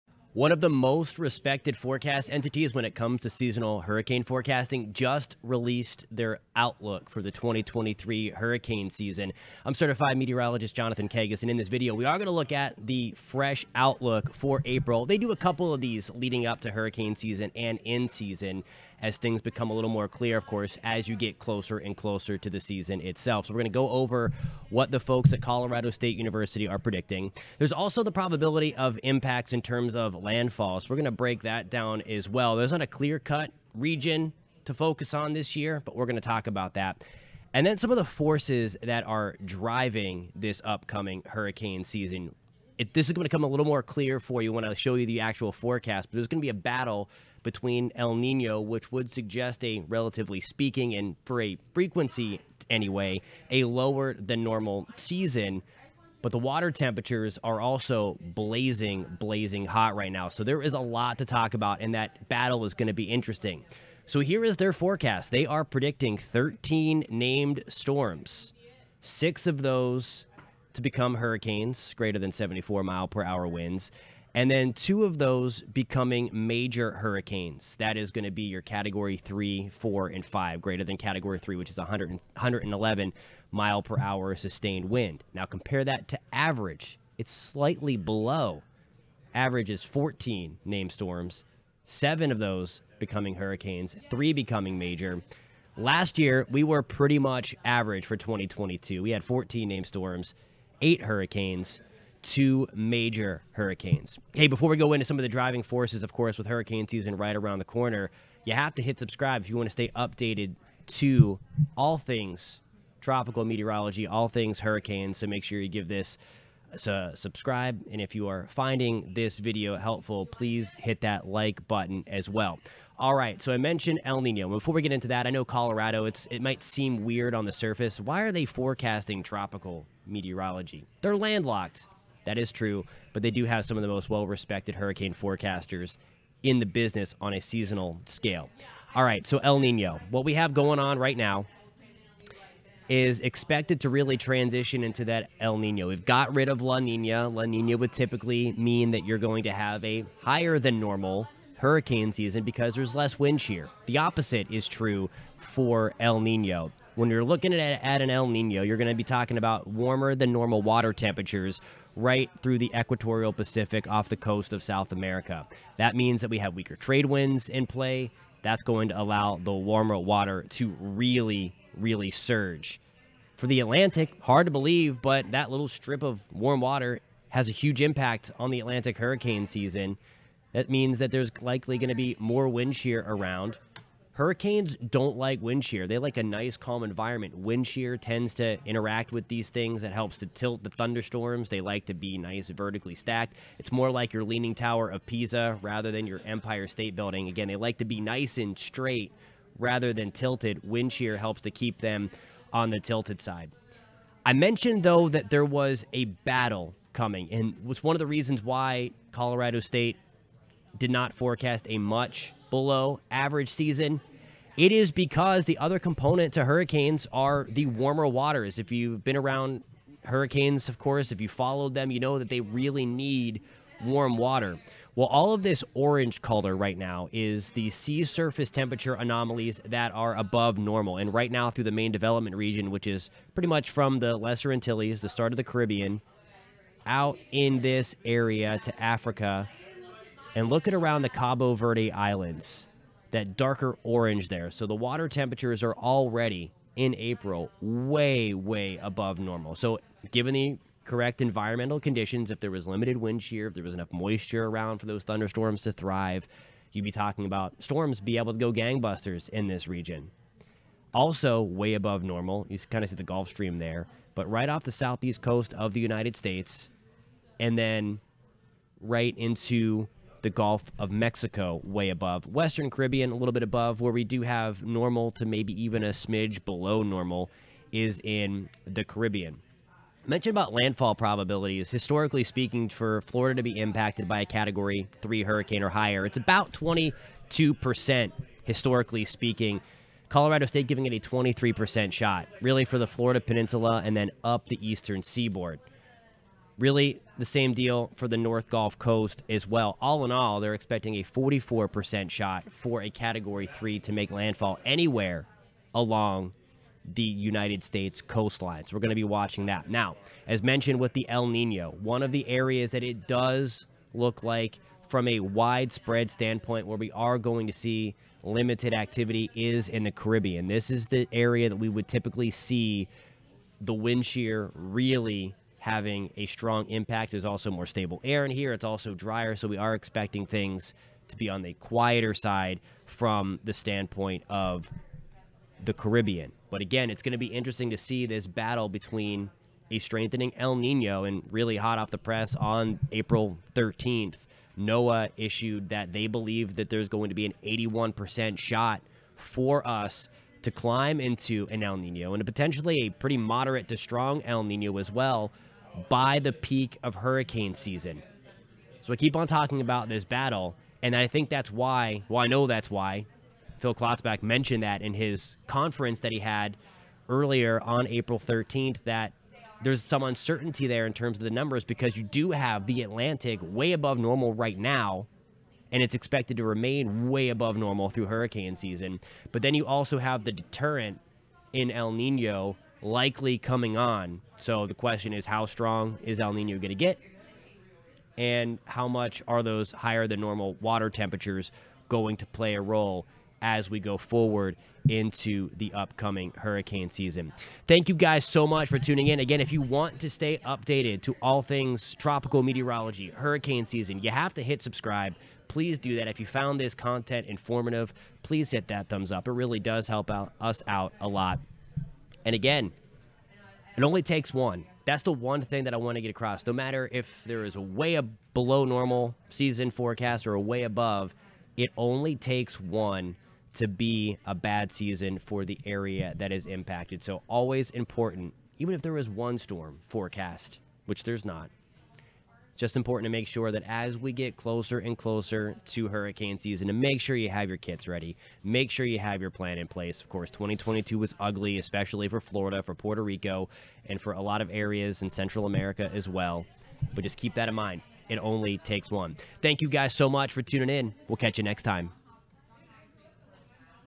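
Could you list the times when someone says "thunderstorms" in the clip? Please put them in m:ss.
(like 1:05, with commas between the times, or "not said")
3:10, 4:15.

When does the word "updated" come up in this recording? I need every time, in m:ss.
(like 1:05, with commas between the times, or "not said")
1:49, 6:40.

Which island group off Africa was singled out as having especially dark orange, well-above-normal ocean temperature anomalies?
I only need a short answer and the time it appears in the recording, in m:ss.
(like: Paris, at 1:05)
Cabo Verde Islands, at 4:01.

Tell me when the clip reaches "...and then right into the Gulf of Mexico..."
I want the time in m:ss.
4:27.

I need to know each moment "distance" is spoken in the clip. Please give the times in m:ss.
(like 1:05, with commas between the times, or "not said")
not said.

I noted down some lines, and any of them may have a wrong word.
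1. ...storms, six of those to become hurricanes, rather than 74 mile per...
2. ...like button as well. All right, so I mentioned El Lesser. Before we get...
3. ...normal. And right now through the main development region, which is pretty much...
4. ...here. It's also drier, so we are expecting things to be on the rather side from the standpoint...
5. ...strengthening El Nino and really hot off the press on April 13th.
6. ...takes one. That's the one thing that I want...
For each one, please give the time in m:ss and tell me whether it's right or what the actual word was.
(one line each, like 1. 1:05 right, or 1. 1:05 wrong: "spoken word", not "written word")
1. 1:07 wrong: "greater", not "rather"
2. 2:01 wrong: "Nino", not "Lesser"
3. 3:50 right
4. 5:28 wrong: "quieter", not "rather"
5. 5:39 right
6. 6:54 right.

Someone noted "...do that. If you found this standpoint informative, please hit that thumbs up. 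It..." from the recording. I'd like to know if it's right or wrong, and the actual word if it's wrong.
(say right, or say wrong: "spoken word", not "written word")
wrong: "content", not "standpoint".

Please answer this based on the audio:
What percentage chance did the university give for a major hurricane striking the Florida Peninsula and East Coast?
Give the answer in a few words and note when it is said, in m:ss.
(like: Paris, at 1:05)
23%, at 4:50.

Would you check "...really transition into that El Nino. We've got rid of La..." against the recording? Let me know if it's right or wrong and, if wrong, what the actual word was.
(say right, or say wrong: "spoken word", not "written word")
right.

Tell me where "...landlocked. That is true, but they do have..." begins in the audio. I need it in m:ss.
2:11.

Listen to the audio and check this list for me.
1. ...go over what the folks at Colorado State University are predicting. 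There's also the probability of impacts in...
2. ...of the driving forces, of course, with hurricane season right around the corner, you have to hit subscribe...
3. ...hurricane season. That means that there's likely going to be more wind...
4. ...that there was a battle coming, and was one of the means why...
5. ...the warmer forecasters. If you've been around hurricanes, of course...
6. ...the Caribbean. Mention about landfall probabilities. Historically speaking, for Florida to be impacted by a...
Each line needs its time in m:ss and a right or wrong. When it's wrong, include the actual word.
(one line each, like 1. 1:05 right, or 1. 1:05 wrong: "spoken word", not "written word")
1. 0:23 right
2. 1:45 right
3. 2:58 right
4. 3:25 wrong: "reasons", not "means"
5. 3:37 wrong: "waters", not "forecasters"
6. 4:38 right.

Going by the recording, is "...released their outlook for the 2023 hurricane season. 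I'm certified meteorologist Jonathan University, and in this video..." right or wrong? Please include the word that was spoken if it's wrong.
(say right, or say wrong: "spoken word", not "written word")
wrong: "Kegges", not "University".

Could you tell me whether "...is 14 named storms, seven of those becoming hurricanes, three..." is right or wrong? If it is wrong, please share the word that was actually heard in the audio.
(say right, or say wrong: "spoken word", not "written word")
right.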